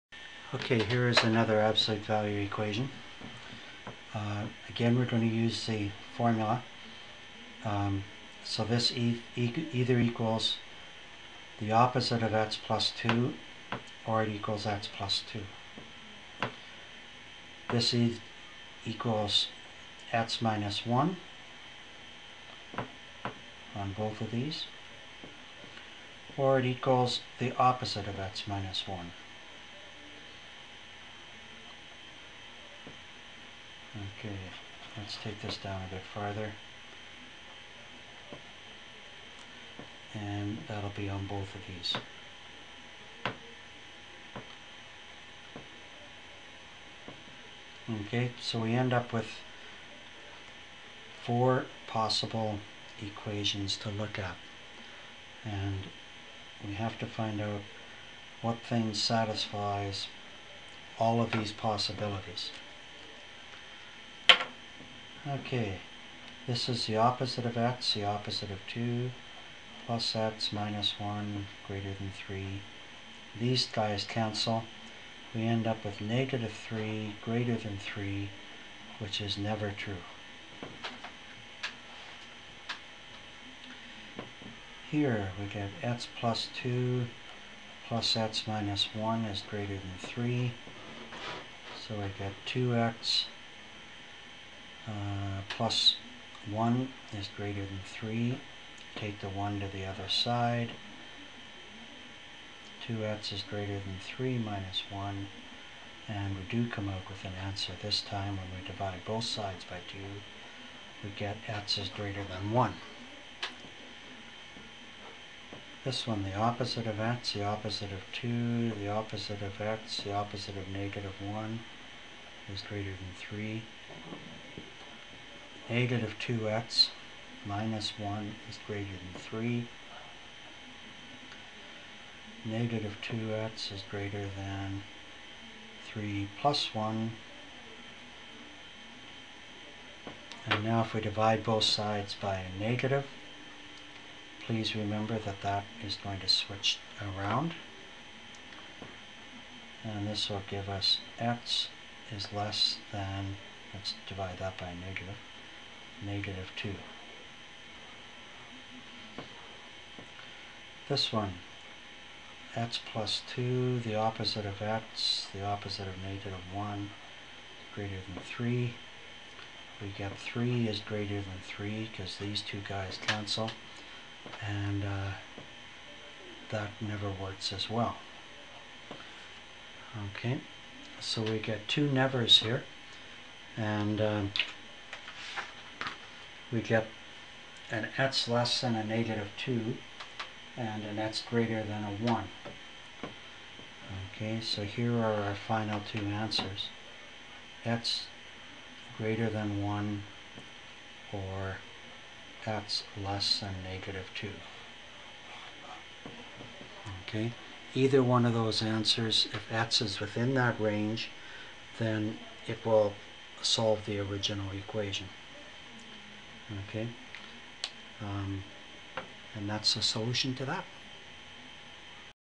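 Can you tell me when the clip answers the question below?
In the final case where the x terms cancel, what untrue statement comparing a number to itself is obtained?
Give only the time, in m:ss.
2:50.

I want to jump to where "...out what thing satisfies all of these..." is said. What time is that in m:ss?
0:57.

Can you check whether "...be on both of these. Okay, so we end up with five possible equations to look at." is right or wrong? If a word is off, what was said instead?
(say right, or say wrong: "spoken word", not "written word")
wrong: "four", not "five".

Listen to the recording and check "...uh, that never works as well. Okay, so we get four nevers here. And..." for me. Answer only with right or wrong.
wrong.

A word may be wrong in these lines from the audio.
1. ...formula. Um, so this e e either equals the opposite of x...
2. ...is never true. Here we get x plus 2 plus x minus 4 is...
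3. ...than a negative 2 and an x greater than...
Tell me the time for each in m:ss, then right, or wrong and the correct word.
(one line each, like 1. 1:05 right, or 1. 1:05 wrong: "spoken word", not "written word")
1. 0:06 right
2. 1:19 wrong: "1", not "4"
3. 3:08 right.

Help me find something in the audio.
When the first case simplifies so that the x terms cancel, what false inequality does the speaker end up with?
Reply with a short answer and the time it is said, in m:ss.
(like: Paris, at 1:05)
-3 > 3, at 1:16.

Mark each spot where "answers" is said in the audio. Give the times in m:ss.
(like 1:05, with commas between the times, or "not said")
1:47, 3:16, 3:28.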